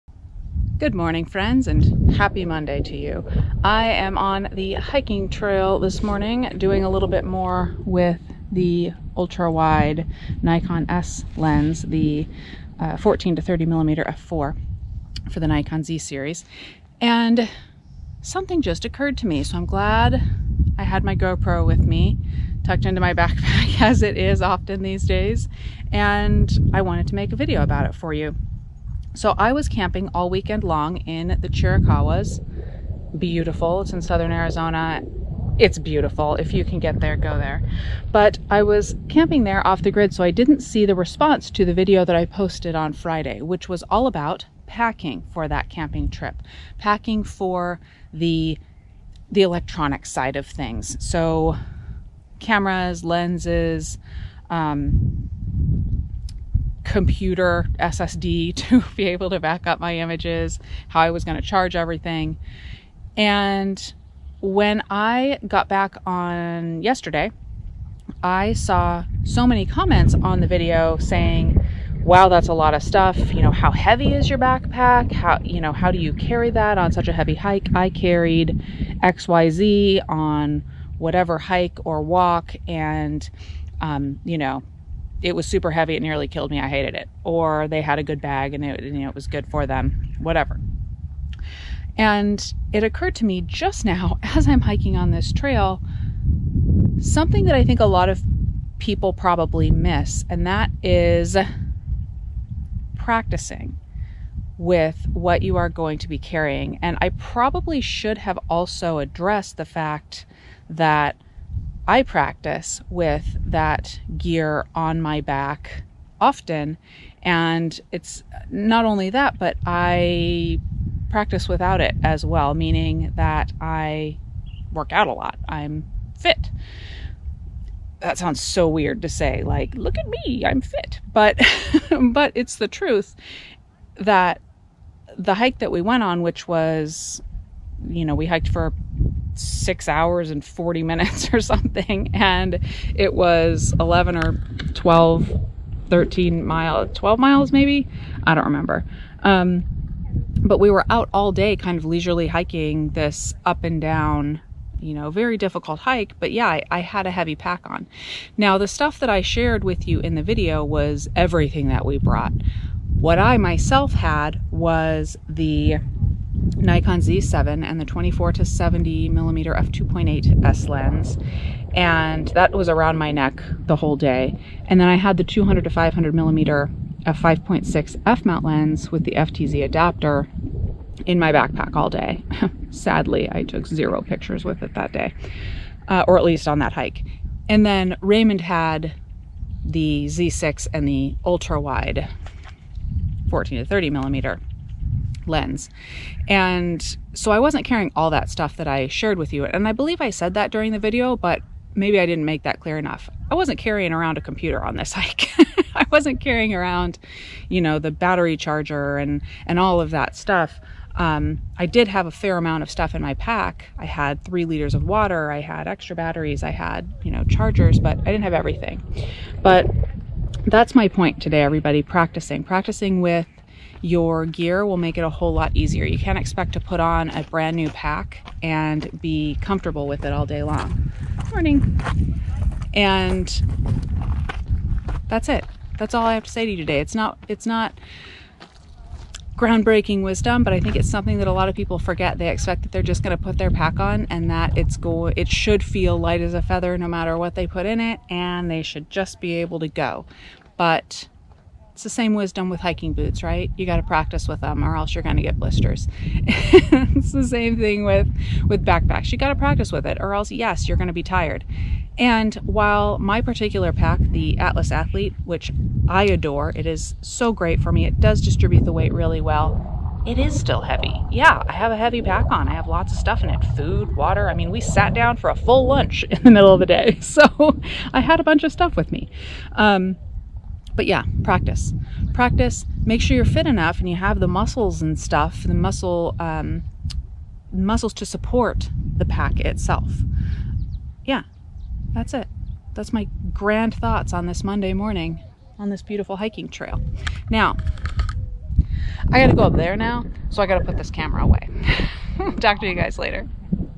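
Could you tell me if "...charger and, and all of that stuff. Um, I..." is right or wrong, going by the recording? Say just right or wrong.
right.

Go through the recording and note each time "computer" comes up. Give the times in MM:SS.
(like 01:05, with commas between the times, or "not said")
00:56, 03:24.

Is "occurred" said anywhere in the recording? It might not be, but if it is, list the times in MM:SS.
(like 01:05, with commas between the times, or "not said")
00:18, 01:32.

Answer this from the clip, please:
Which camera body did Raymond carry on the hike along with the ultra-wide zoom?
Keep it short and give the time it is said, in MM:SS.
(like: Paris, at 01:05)
Nikon Z6, at 03:10.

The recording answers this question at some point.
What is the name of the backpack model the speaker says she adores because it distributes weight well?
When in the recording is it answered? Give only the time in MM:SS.
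04:24.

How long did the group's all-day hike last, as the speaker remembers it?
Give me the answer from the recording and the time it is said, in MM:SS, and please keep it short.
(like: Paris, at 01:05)
6 hours 40 minutes, at 02:19.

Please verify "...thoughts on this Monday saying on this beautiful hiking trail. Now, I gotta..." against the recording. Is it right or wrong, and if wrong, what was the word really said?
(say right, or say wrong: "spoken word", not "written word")
wrong: "morning", not "saying".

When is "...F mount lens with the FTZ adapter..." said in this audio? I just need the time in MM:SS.
02:58.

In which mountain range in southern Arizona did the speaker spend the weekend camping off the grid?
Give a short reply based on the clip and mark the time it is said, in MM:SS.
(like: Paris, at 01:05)
Chiricahuas, at 00:31.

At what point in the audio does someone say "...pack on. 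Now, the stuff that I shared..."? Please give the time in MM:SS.
02:37.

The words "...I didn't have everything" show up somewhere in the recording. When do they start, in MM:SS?
03:37.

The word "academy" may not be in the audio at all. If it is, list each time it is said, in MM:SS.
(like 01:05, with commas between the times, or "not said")
not said.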